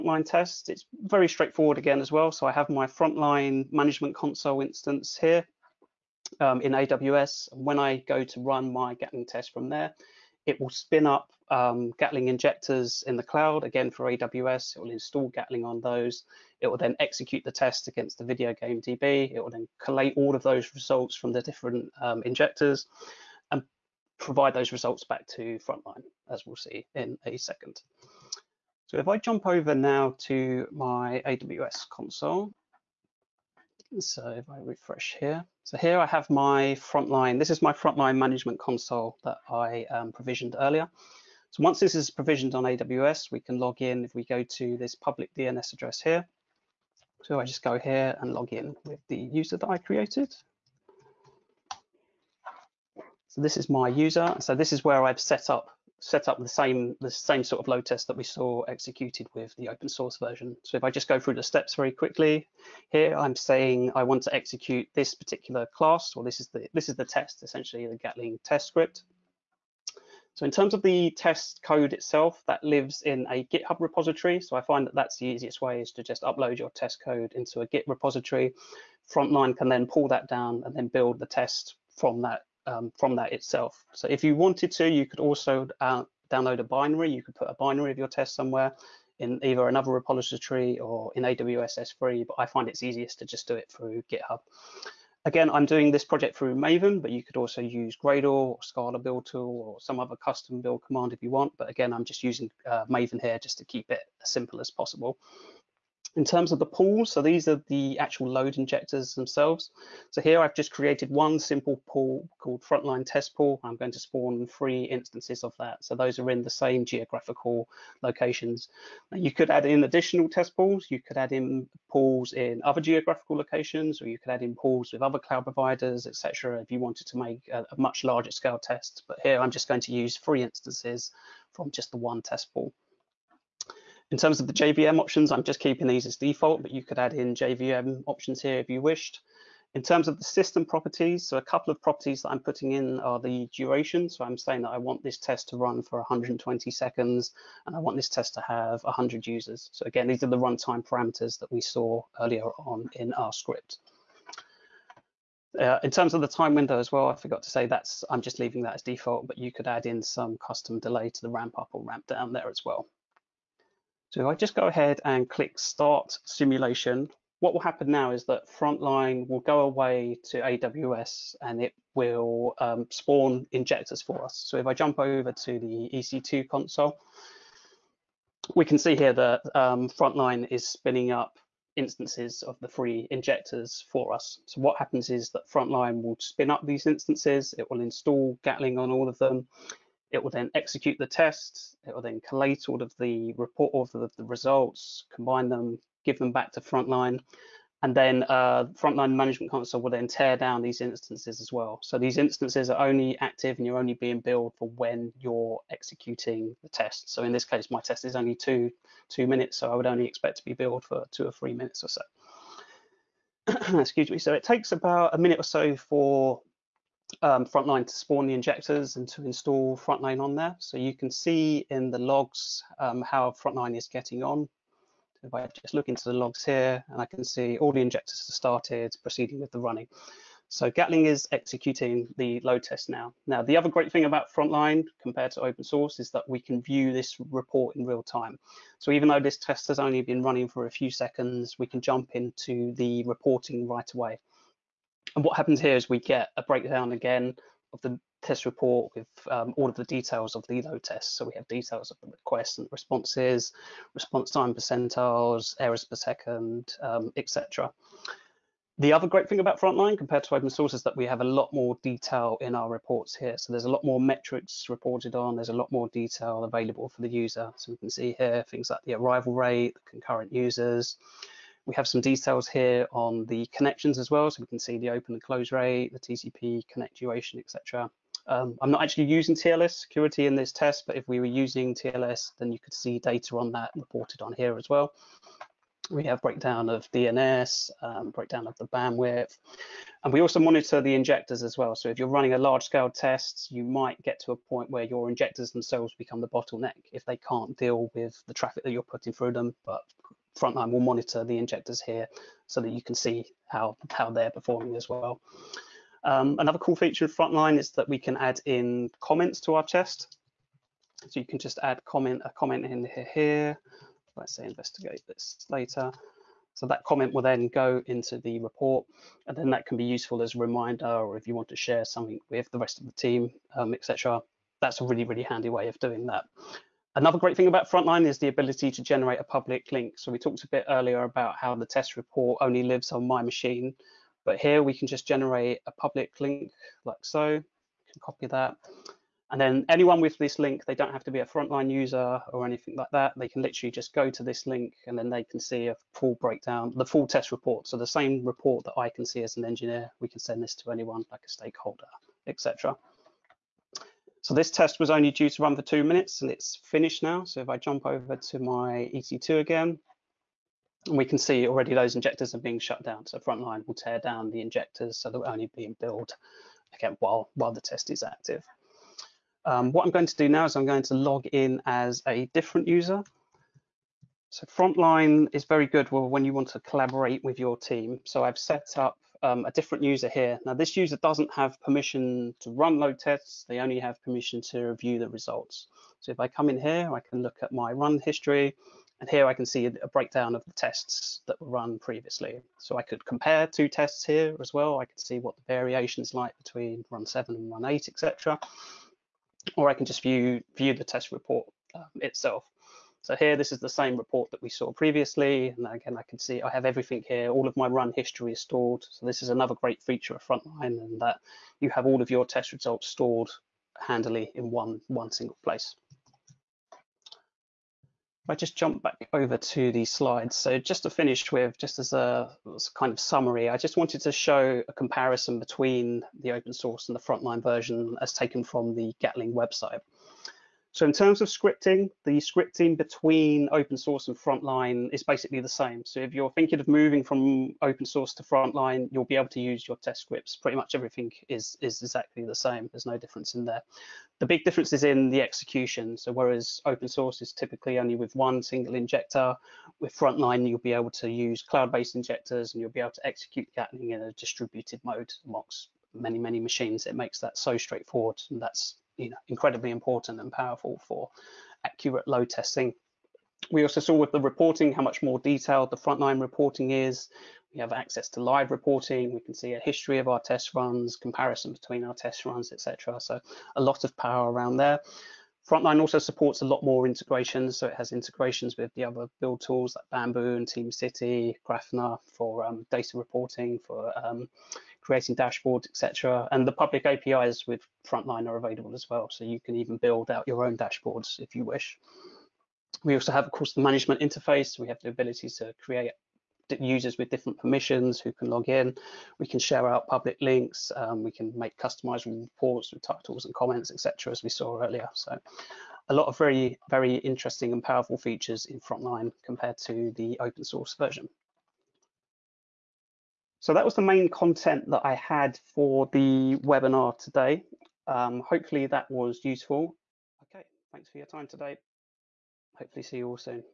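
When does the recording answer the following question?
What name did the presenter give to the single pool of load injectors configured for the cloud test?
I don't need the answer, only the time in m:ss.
1:52.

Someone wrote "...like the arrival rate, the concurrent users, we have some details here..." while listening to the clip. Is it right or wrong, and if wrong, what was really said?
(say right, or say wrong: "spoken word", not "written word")
right.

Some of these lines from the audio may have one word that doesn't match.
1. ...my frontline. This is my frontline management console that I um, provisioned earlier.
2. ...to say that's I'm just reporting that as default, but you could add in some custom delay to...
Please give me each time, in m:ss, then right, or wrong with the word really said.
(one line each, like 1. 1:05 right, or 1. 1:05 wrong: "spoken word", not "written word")
1. 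0:36 right
2. 2:37 wrong: "leaving", not "reporting".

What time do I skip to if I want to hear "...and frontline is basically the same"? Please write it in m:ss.
7:14.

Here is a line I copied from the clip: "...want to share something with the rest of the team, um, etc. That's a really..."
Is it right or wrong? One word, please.
right.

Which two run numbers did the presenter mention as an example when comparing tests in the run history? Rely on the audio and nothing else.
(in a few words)
7 and 8.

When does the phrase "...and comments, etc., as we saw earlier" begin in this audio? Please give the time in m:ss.
8:23.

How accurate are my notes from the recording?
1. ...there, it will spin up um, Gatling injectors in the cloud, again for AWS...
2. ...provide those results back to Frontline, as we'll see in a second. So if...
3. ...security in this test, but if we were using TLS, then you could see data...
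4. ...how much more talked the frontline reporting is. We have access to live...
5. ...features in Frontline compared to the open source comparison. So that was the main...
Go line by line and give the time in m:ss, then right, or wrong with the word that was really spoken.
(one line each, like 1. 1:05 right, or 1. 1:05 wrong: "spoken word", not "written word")
1. 0:09 right
2. 0:24 right
3. 4:39 right
4. 7:44 wrong: "detailed", not "talked"
5. 8:27 wrong: "version", not "comparison".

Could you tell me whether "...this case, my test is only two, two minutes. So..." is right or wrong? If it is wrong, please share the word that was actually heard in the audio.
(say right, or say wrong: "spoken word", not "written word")
right.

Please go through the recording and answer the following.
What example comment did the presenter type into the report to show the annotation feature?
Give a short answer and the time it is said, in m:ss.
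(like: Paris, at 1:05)
investigate this later, at 5:14.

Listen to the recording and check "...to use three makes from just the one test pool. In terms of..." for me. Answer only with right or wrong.
wrong.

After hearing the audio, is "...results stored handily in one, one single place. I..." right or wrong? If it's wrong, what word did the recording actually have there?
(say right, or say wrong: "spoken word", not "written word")
right.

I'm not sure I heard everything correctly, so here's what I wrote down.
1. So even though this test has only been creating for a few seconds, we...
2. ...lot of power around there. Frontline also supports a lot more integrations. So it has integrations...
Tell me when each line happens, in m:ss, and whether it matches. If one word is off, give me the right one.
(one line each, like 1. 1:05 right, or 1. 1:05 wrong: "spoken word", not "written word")
1. 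3:58 wrong: "running", not "creating"
2. 7:53 right.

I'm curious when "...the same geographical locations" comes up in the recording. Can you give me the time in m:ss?
1:56.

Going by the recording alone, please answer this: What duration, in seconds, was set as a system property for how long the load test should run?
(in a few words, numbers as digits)
120.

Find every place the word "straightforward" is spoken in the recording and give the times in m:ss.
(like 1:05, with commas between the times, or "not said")
0:01, 7:37.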